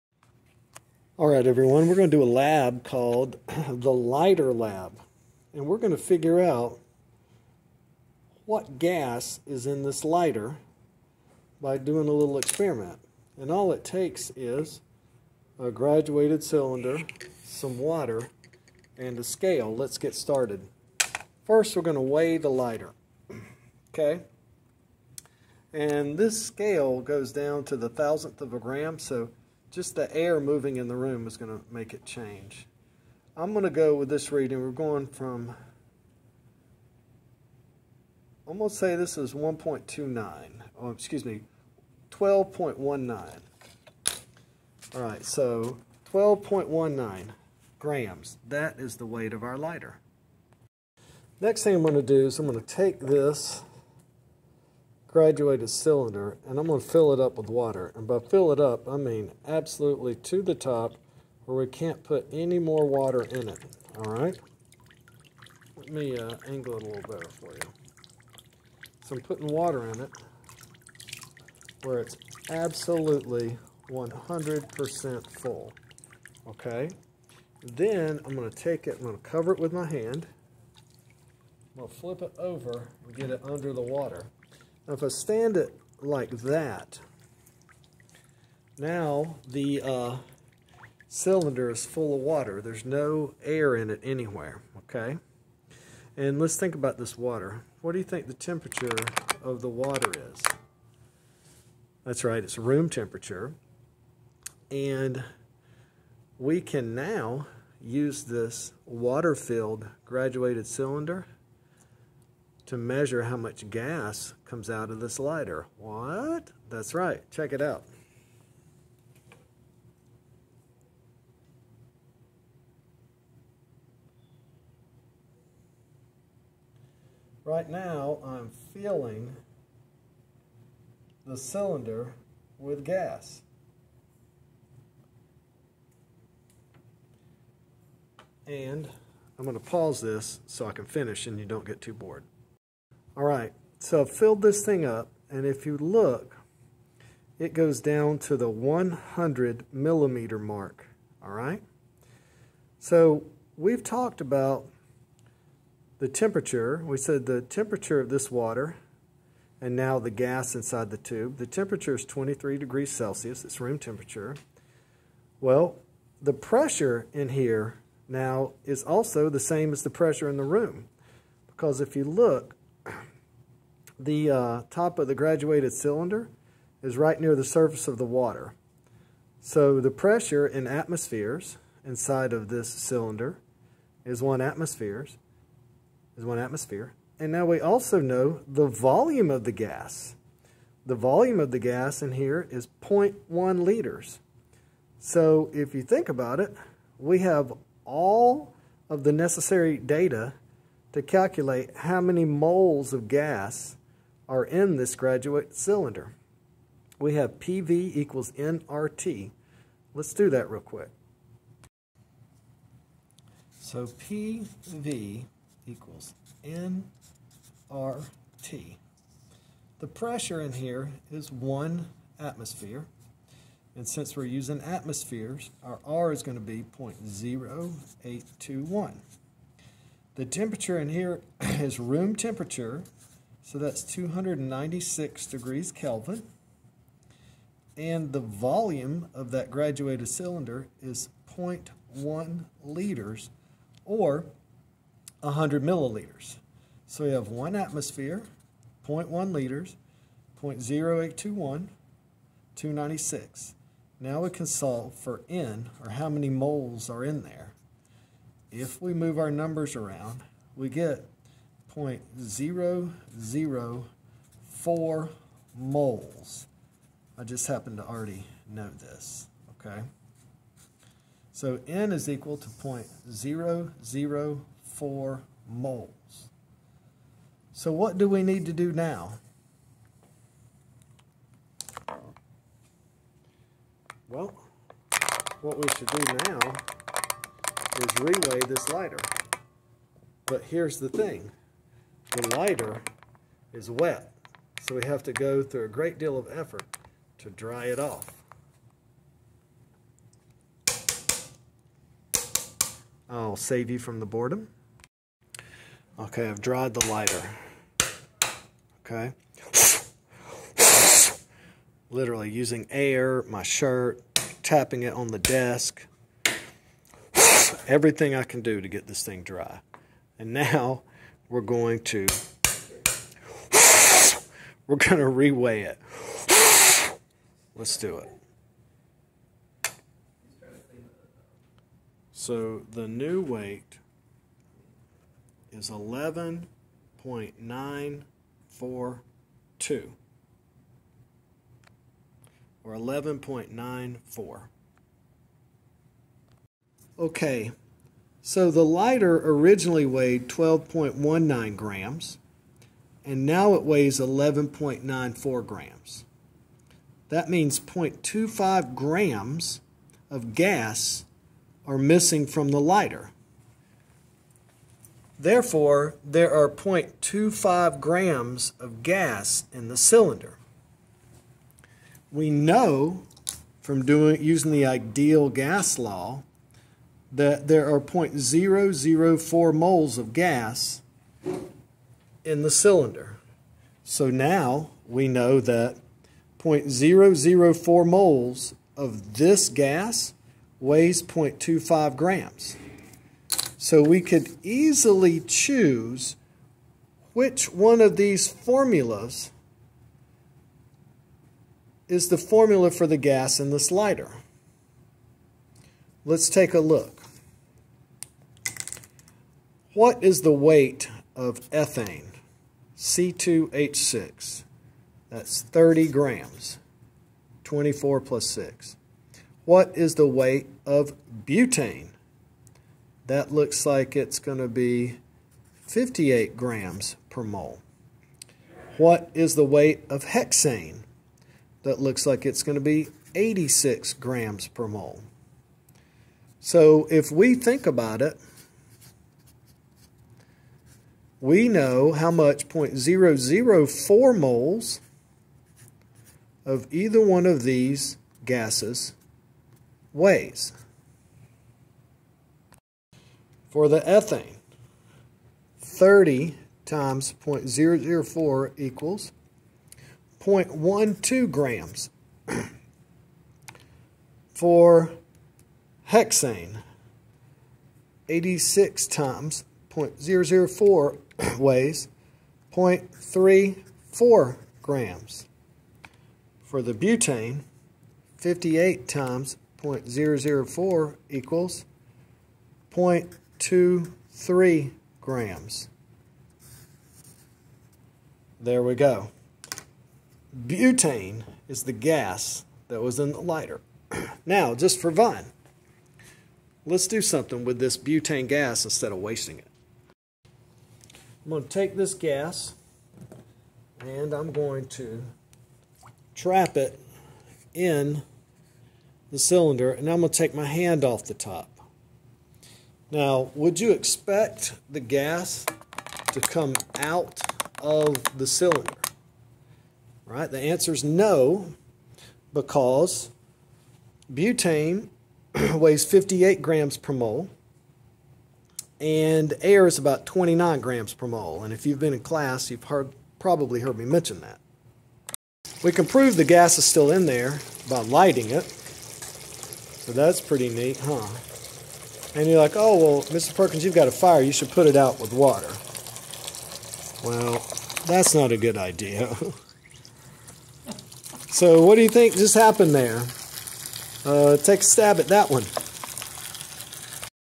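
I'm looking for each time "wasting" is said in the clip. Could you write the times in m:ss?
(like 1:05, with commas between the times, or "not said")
8:18.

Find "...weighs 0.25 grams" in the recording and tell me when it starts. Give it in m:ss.
6:30.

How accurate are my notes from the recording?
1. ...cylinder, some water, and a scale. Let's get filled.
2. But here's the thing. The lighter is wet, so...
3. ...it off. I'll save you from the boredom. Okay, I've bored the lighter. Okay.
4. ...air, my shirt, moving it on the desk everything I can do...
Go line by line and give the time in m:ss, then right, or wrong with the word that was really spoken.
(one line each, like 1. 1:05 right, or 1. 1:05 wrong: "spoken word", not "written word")
1. 0:16 wrong: "started", not "filled"
2. 4:50 right
3. 4:57 wrong: "dried", not "bored"
4. 5:12 wrong: "tapping", not "moving".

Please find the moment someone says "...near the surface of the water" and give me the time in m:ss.
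2:57.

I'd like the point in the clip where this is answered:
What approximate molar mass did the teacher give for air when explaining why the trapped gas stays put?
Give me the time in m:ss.
8:50.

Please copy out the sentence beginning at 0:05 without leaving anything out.
And we're going to figure out what gas is in this lighter by doing a little experiment.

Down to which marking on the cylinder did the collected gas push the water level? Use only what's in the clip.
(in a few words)
100 millimeter mark.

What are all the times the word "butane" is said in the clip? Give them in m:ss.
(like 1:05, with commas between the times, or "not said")
7:01, 7:56, 8:10, 8:17, 8:44.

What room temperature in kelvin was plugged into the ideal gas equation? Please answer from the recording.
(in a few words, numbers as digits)
296 degrees Kelvin.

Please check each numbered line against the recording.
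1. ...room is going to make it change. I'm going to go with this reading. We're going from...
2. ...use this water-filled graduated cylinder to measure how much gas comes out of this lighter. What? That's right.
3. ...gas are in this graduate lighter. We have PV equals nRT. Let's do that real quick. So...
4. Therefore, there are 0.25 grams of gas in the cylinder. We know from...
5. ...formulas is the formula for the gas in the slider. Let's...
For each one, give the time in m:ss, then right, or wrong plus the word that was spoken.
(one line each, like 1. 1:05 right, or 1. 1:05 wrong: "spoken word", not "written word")
1. 0:30 right
2. 1:47 right
3. 3:23 wrong: "cylinder", not "lighter"
4. 6:05 right
5. 6:38 right.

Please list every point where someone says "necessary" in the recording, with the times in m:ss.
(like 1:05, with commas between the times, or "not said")
3:19.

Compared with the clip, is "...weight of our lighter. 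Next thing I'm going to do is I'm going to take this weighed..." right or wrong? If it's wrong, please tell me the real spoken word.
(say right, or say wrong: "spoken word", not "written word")
wrong: "graduated", not "weighed".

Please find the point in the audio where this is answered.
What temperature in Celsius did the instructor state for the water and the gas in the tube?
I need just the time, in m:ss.
2:42.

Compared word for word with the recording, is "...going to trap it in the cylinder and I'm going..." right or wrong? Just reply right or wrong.
right.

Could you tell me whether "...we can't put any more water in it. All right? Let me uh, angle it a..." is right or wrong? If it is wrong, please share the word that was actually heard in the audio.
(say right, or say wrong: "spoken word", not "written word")
right.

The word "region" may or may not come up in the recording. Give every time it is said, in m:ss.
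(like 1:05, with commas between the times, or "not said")
not said.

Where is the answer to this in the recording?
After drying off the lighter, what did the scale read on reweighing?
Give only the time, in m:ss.
5:35.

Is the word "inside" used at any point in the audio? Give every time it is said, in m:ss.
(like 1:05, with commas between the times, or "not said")
2:40, 3:01.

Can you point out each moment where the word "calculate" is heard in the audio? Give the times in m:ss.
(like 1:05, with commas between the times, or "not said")
3:21.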